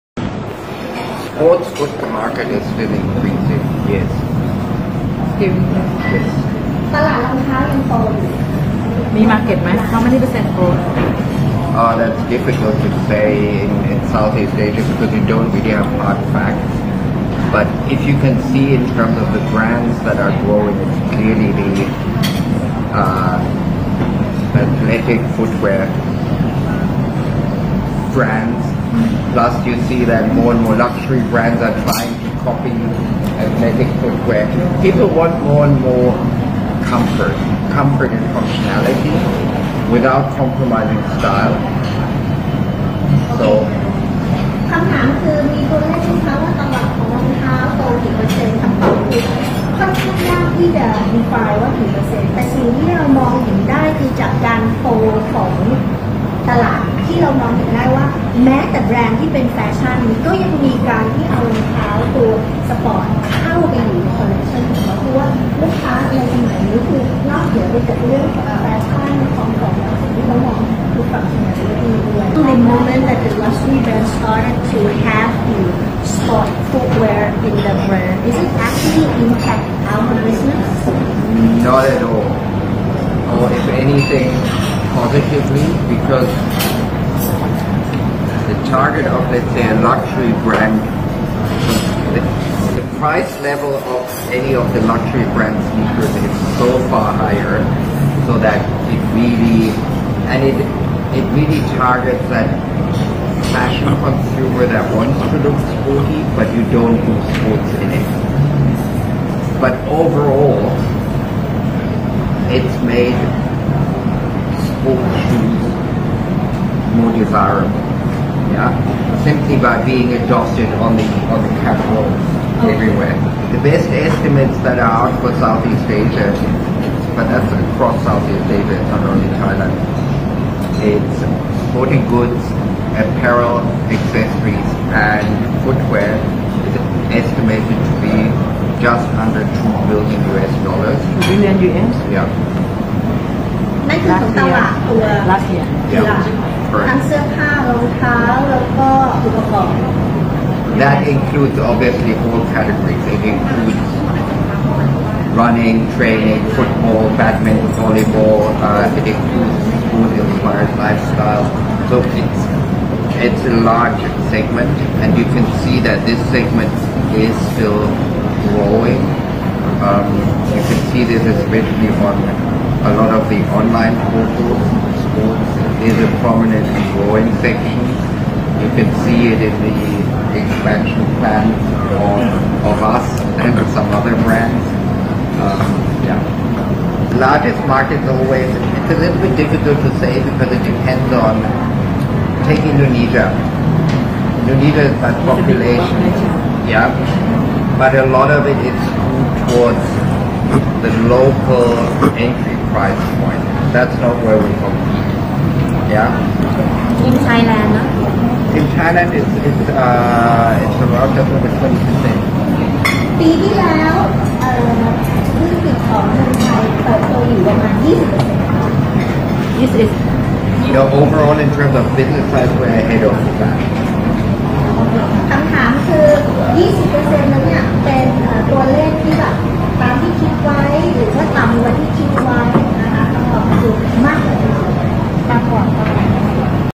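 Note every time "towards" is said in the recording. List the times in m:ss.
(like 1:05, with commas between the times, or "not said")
3:19.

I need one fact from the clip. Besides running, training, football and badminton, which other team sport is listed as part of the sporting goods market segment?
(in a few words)
volleyball.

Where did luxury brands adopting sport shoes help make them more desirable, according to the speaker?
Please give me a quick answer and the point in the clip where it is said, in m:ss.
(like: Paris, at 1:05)
on the catwalks, at 2:01.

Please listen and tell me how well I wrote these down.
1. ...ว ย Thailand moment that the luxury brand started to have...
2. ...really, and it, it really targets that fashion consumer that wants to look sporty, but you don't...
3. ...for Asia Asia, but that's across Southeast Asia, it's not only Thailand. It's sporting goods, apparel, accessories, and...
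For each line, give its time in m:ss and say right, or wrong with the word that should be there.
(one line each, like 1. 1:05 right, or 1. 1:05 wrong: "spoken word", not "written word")
1. 1:12 wrong: "The", not "Thailand"
2. 1:39 right
3. 2:05 wrong: "Southeast", not "Asia".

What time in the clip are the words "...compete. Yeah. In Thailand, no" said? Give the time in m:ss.
3:24.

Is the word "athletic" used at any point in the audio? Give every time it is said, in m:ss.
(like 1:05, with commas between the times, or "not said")
0:24, 0:33.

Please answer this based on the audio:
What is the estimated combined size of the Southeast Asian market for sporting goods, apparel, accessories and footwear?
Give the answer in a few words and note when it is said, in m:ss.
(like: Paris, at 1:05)
just under 2 billion US dollars, at 2:18.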